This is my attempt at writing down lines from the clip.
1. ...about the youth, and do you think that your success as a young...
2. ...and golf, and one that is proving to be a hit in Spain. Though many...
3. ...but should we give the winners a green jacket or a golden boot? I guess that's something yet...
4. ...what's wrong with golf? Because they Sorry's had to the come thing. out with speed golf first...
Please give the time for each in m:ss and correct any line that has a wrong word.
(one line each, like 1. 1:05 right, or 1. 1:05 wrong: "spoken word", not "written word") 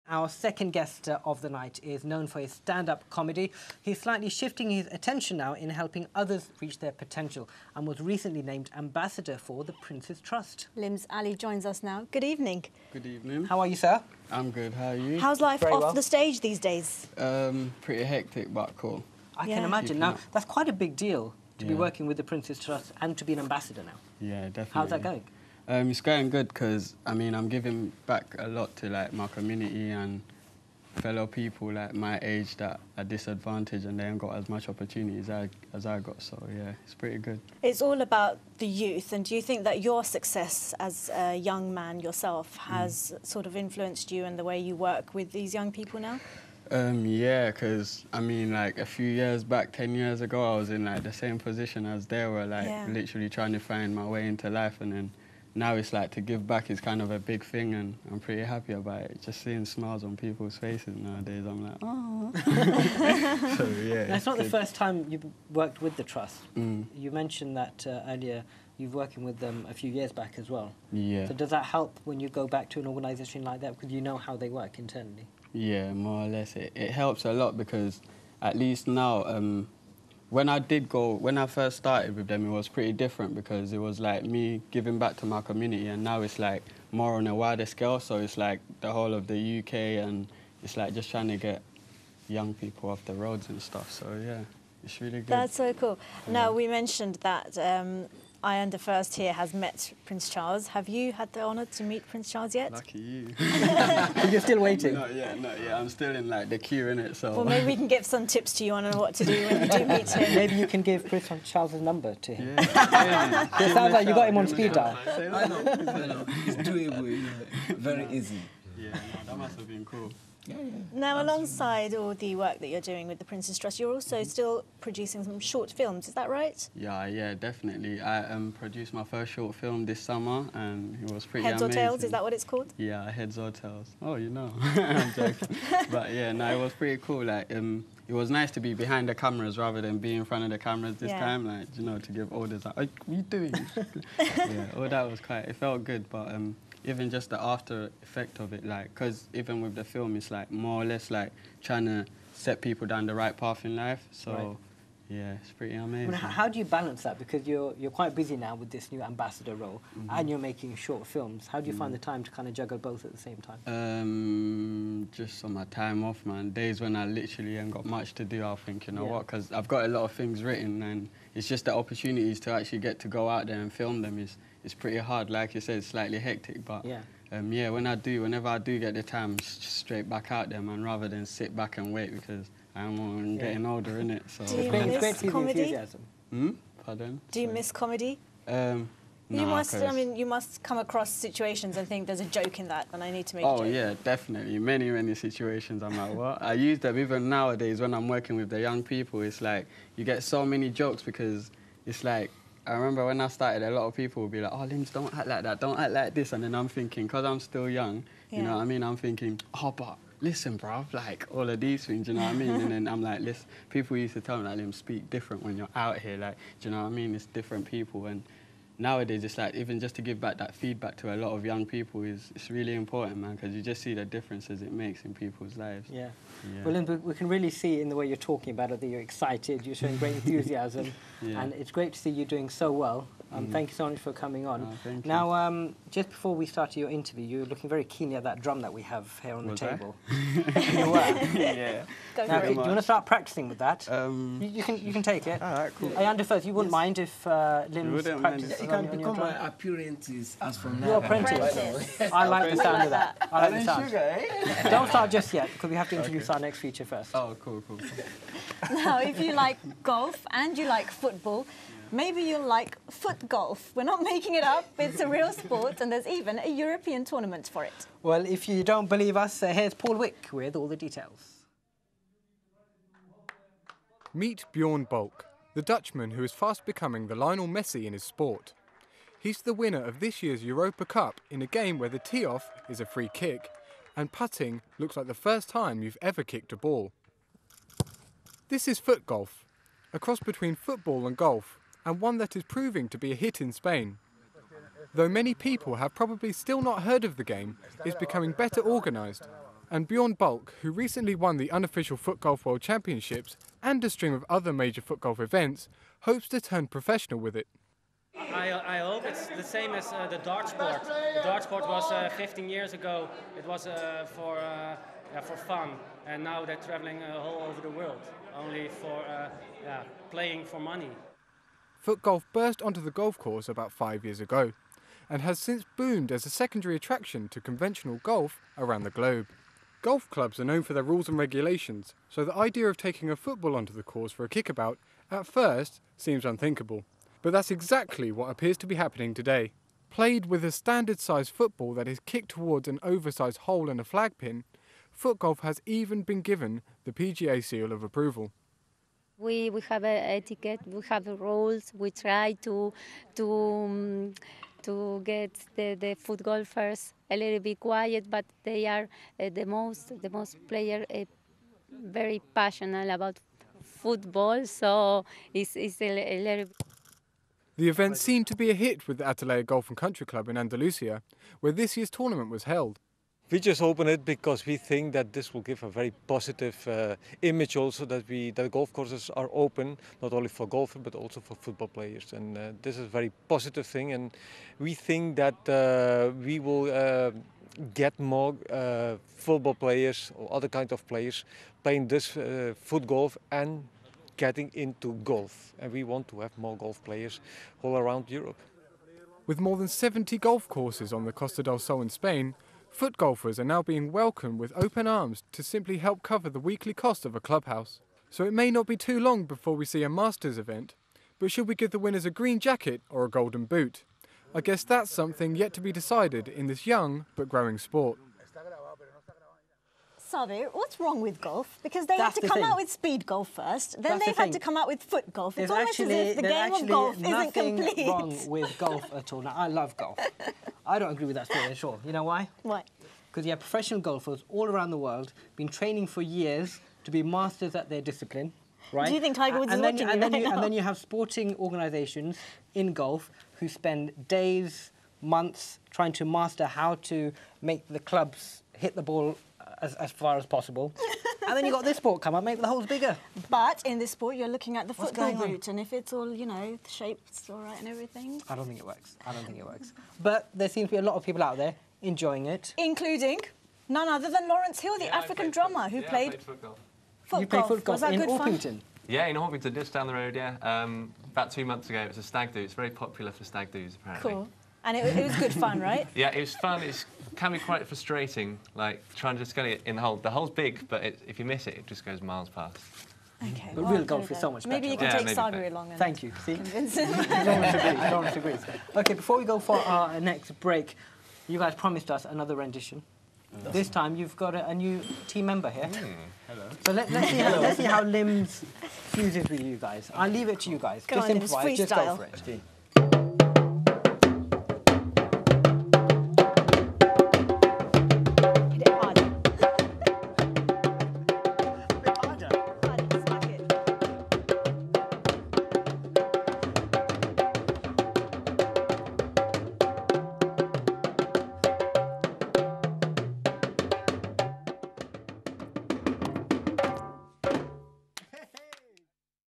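1. 0:38 right
2. 4:51 right
3. 6:51 right
4. 7:00 wrong: "That", not "Sorry".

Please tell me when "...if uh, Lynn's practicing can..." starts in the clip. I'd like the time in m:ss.
4:06.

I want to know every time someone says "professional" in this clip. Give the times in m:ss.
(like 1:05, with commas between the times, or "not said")
5:06, 7:13.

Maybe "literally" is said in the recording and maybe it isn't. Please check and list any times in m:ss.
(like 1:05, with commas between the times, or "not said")
0:52, 2:47.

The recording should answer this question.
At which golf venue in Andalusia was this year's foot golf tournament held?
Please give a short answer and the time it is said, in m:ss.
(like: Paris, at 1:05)
Atalaya Golf and Country Club, at 6:09.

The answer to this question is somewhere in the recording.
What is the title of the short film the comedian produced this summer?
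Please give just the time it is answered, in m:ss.
2:13.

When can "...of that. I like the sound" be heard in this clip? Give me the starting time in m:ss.
4:12.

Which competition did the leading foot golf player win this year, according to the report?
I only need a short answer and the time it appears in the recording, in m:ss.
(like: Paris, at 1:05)
Europa Cup, at 4:40.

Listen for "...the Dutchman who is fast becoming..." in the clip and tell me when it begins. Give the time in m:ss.
4:35.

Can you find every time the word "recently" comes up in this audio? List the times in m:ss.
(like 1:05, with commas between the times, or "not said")
0:08, 5:00.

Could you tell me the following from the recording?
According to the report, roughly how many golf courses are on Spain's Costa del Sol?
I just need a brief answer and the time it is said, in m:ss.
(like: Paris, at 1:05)
More than 70, at 6:39.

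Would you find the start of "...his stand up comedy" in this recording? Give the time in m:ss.
0:02.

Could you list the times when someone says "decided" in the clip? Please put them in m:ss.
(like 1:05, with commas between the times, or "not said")
6:55.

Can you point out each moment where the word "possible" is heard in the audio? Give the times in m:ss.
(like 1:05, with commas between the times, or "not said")
7:30.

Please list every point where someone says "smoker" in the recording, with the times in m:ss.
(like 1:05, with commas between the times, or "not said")
not said.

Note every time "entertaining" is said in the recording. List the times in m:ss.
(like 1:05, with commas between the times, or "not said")
not said.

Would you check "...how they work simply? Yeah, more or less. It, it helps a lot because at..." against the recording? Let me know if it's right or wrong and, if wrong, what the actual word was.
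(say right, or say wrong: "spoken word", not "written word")
wrong: "internally", not "simply".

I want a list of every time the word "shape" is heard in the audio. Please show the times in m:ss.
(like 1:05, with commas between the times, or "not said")
7:36.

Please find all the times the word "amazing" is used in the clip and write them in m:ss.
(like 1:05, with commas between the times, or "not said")
2:11, 2:35.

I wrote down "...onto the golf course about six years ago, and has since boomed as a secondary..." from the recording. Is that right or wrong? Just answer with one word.
wrong.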